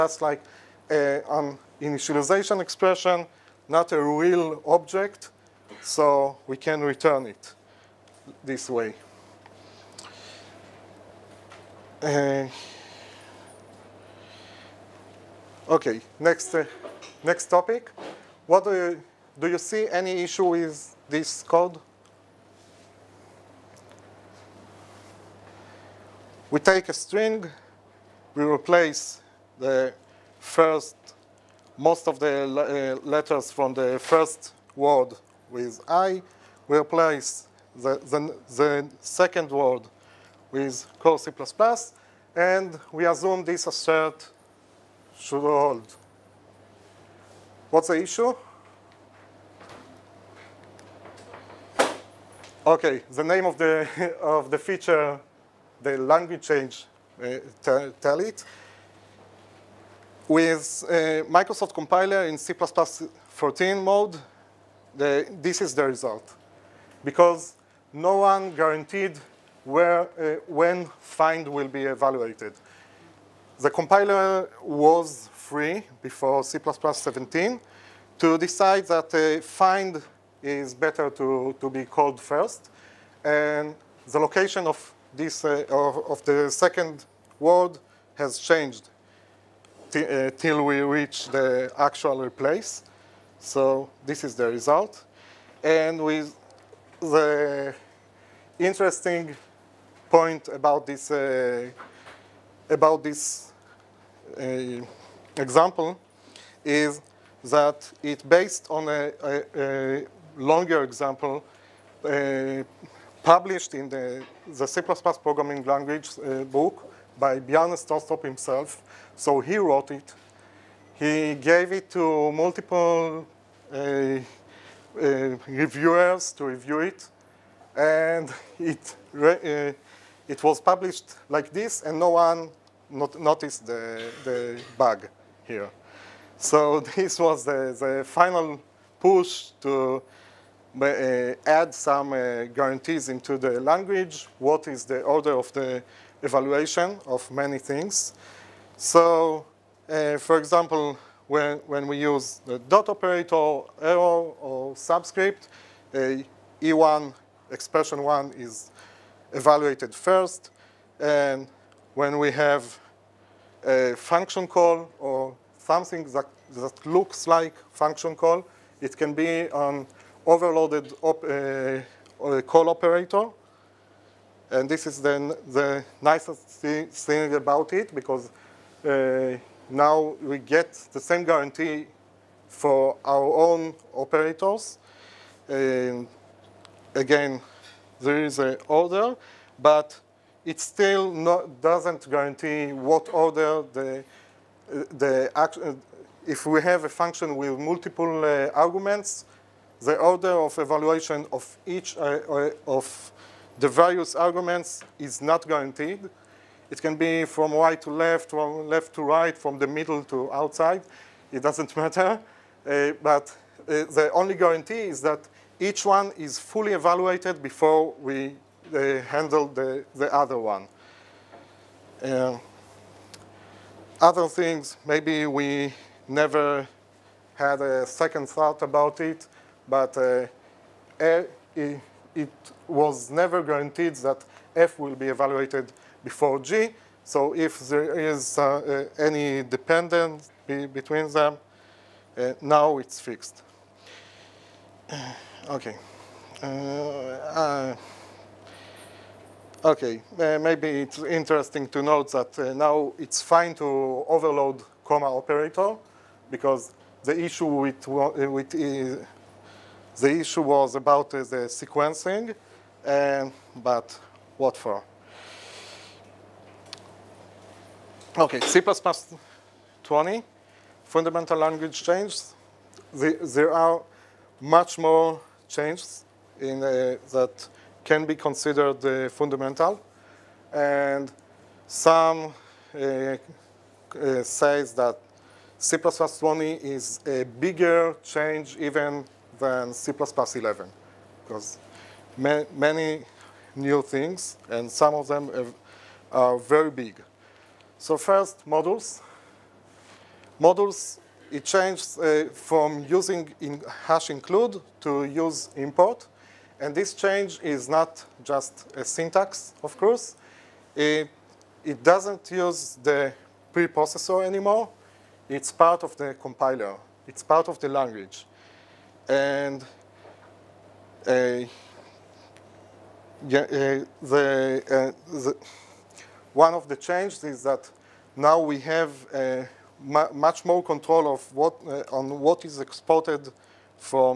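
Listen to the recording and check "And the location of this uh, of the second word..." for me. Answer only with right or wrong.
right.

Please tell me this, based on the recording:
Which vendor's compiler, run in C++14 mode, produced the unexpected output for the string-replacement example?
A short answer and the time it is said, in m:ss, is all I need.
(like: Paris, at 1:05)
Microsoft, at 1:01.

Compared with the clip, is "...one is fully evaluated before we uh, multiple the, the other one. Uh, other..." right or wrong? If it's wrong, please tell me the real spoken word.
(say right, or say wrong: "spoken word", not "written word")
wrong: "handle", not "multiple".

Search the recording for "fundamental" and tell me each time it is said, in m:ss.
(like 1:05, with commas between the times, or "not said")
4:30, 4:39.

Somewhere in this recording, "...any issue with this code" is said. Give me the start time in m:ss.
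0:19.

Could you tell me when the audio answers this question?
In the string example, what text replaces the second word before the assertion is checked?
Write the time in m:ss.
0:40.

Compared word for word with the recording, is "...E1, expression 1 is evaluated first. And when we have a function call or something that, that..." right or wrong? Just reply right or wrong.
right.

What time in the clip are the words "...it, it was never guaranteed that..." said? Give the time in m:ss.
3:50.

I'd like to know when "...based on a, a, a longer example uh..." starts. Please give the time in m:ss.
1:48.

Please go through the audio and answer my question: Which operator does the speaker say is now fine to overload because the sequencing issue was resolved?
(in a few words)
comma operator.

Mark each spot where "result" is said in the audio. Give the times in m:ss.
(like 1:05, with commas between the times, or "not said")
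1:05, 1:34.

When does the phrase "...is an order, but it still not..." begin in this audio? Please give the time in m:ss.
3:08.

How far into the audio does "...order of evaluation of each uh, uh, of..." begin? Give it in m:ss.
3:19.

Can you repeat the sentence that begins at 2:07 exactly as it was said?
And it, uh, it was published like this, and no one not noticed the, the bug here.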